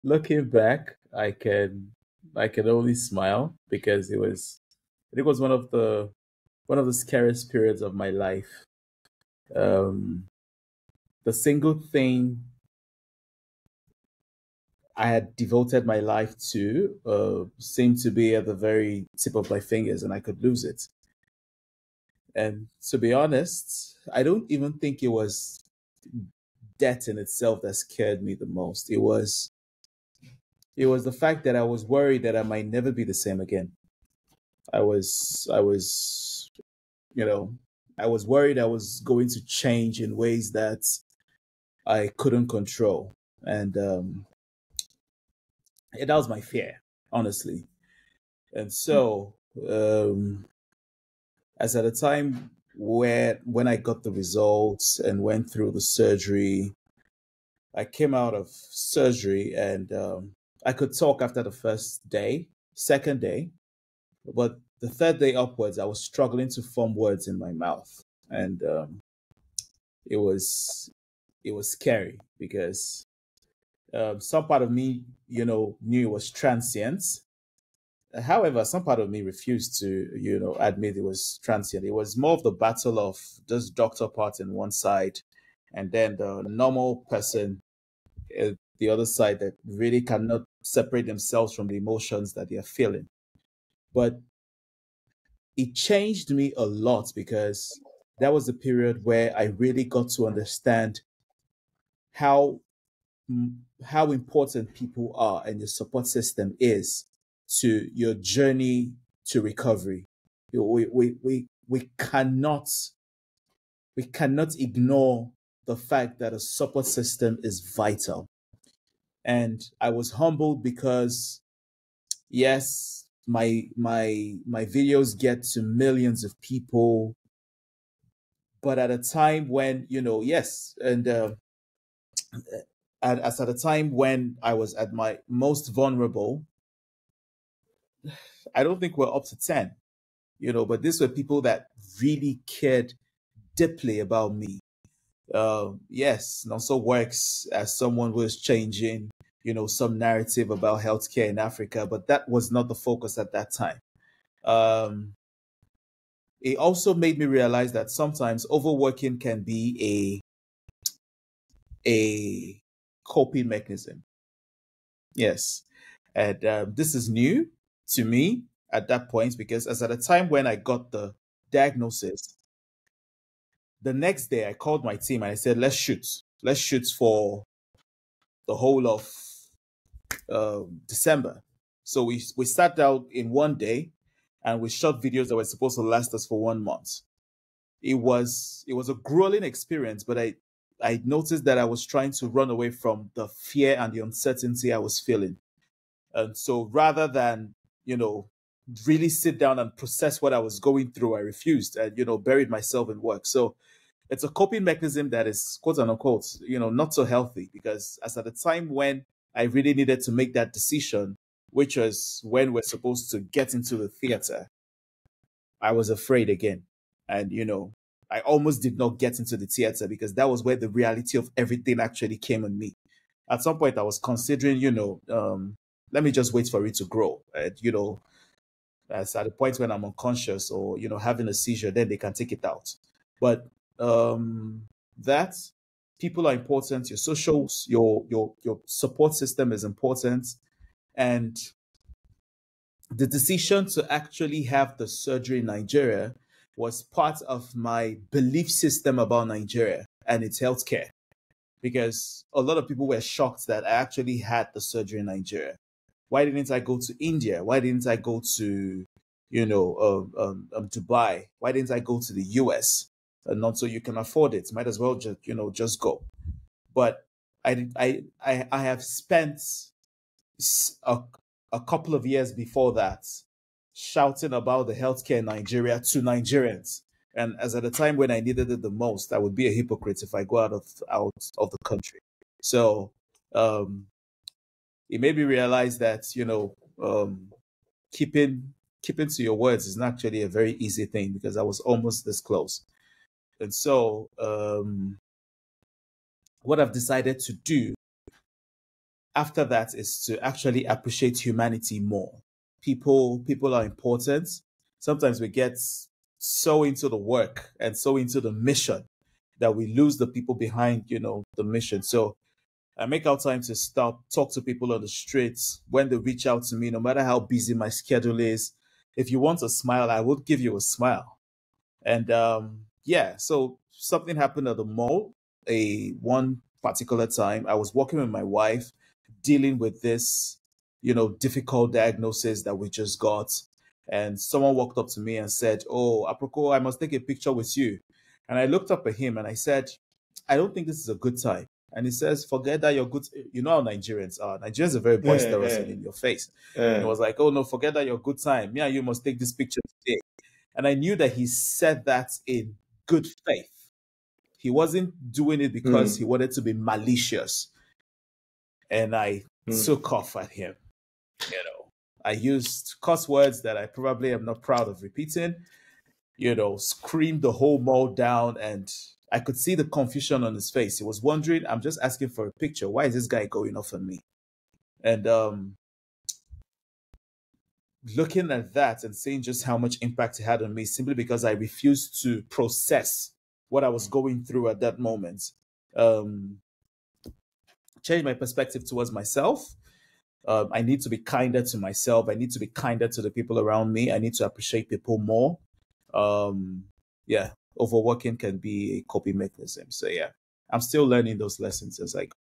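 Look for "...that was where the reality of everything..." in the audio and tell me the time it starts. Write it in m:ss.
3:40.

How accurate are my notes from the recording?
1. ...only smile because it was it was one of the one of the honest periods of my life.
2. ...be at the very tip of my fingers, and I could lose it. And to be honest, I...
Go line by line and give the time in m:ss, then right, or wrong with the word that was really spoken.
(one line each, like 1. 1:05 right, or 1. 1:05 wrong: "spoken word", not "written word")
1. 0:02 wrong: "scariest", not "honest"
2. 0:18 right.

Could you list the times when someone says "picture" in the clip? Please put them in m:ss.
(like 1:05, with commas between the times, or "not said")
5:36, 5:49, 6:12.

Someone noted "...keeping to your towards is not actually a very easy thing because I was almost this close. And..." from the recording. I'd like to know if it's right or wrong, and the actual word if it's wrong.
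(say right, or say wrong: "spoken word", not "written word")
wrong: "words", not "towards".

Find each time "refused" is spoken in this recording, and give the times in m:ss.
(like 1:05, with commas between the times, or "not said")
1:19, 3:21, 6:21.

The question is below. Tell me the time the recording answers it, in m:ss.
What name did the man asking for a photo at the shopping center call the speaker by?
5:36.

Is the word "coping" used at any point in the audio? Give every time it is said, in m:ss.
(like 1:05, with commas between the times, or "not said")
2:43, 3:24, 6:38.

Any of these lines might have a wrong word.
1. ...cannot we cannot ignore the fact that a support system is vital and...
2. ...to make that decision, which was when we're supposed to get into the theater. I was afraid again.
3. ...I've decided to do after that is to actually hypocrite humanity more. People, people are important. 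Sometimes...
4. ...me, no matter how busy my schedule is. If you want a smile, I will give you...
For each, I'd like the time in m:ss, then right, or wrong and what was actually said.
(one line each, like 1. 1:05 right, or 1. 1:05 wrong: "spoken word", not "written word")
1. 1:51 right
2. 3:30 right
3. 4:56 wrong: "appreciate", not "hypocrite"
4. 5:16 right.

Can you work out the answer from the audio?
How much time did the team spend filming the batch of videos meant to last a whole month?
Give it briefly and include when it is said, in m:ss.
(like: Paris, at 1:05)
1 day, at 3:03.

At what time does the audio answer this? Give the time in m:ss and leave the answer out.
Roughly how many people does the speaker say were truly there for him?
2:19.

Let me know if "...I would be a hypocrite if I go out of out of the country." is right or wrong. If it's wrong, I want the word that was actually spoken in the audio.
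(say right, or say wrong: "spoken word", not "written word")
right.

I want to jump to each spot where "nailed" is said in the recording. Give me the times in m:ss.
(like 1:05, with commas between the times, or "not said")
not said.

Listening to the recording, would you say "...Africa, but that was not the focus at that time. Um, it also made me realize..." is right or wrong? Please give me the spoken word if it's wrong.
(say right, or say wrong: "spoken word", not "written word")
right.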